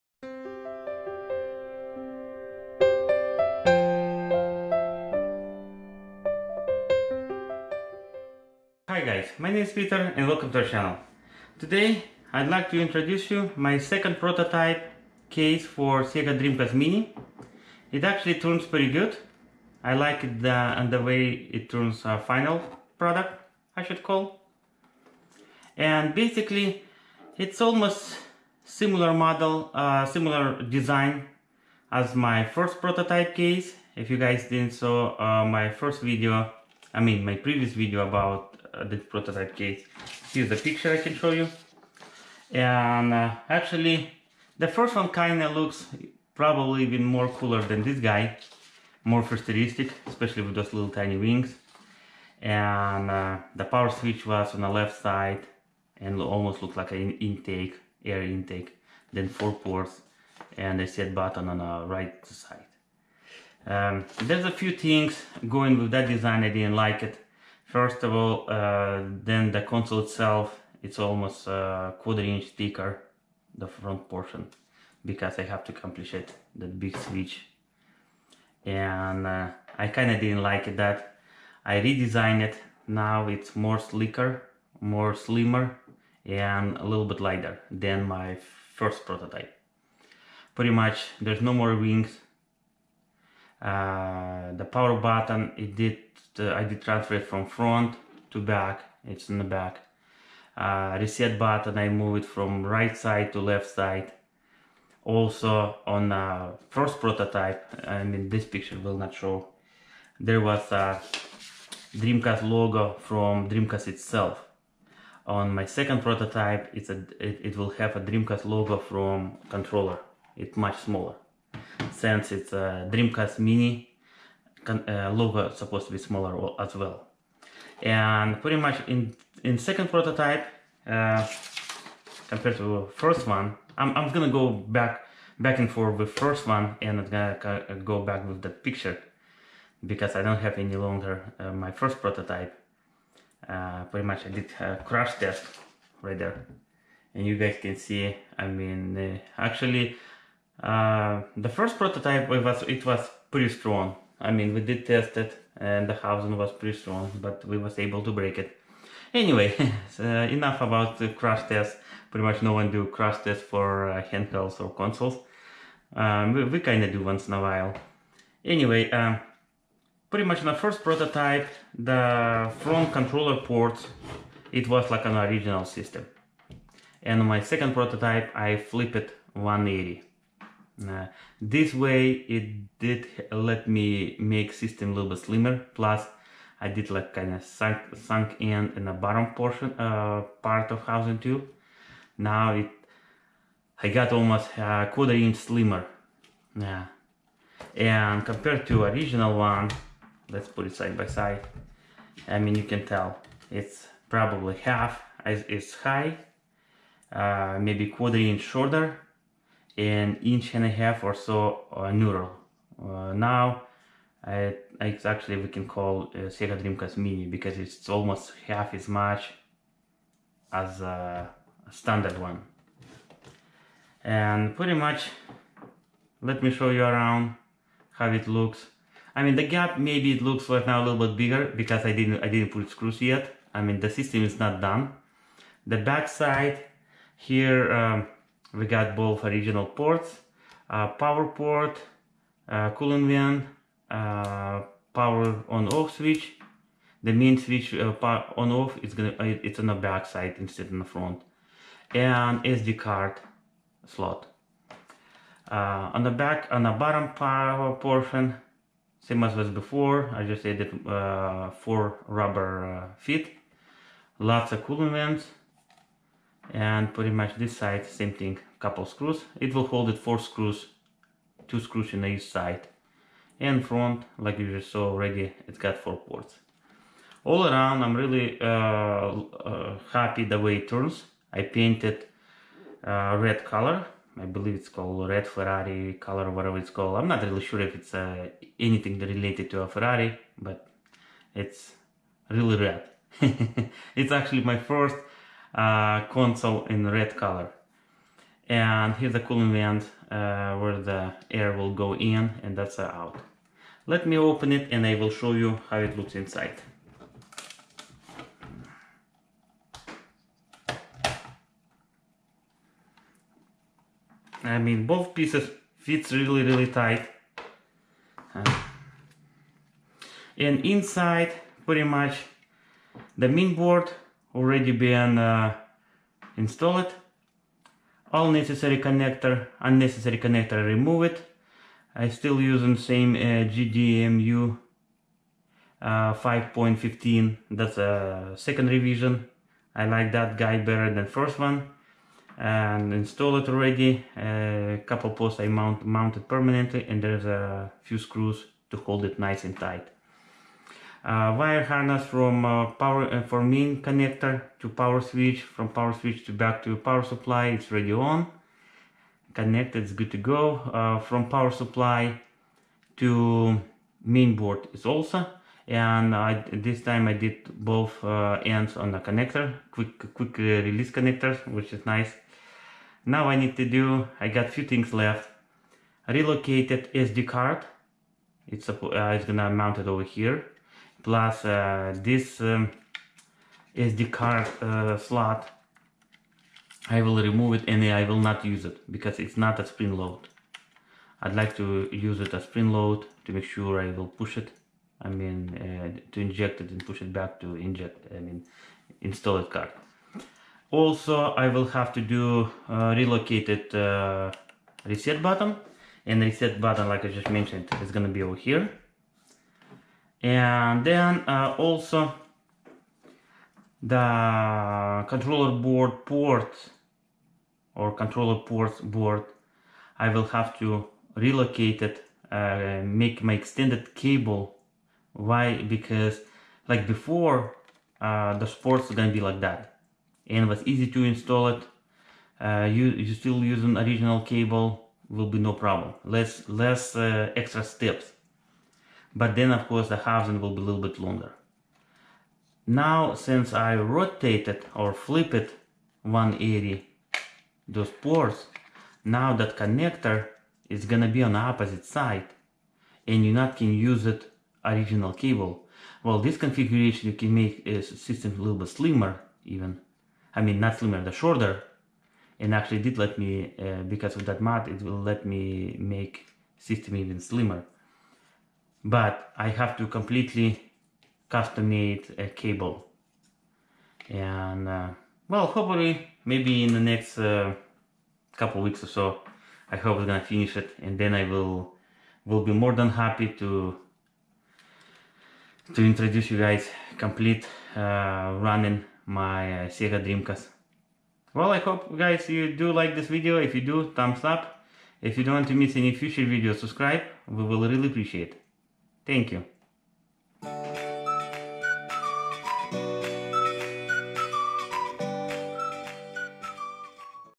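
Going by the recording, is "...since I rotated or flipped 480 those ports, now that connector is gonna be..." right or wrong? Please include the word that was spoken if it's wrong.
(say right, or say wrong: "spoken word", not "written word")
wrong: "180", not "480".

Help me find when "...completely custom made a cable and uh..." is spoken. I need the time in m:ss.
7:49.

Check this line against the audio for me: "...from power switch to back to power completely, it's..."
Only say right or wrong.
wrong.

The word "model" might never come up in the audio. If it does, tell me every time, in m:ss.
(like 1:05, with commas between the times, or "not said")
0:29.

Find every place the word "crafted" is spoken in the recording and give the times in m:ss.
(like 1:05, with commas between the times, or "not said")
not said.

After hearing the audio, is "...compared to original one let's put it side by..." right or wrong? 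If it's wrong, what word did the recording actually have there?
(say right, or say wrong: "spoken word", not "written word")
right.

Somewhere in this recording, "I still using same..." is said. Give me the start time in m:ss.
5:31.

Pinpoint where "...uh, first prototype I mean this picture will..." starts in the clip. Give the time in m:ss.
1:46.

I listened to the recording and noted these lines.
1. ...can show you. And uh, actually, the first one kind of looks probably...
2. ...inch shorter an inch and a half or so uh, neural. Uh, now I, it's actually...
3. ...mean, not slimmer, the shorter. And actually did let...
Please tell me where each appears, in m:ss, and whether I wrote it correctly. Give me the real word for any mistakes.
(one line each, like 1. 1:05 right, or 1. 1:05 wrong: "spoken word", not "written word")
1. 0:40 right
2. 3:28 right
3. 7:40 right.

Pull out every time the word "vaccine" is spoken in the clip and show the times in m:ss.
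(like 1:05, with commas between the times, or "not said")
not said.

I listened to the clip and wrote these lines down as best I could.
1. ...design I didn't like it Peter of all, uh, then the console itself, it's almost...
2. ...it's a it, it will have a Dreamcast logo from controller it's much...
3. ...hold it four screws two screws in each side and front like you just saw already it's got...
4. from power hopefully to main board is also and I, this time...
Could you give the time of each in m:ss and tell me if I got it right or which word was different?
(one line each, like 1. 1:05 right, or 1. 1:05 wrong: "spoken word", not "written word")
1. 1:06 wrong: "First", not "Peter"
2. 1:56 right
3. 4:29 right
4. 6:01 wrong: "supply", not "hopefully".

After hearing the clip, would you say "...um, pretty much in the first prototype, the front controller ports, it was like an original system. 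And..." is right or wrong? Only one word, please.
right.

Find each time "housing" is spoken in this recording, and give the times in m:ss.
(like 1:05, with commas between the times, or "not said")
2:35, 3:10, 7:19.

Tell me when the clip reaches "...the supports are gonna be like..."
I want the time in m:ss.
7:08.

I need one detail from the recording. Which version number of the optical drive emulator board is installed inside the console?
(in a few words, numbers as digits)
5.15.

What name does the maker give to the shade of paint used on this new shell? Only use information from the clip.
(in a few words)
Red Ferrari.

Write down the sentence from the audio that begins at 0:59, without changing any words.
Then four ports and a set button on the right side.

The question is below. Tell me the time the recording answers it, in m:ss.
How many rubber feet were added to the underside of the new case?
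4:21.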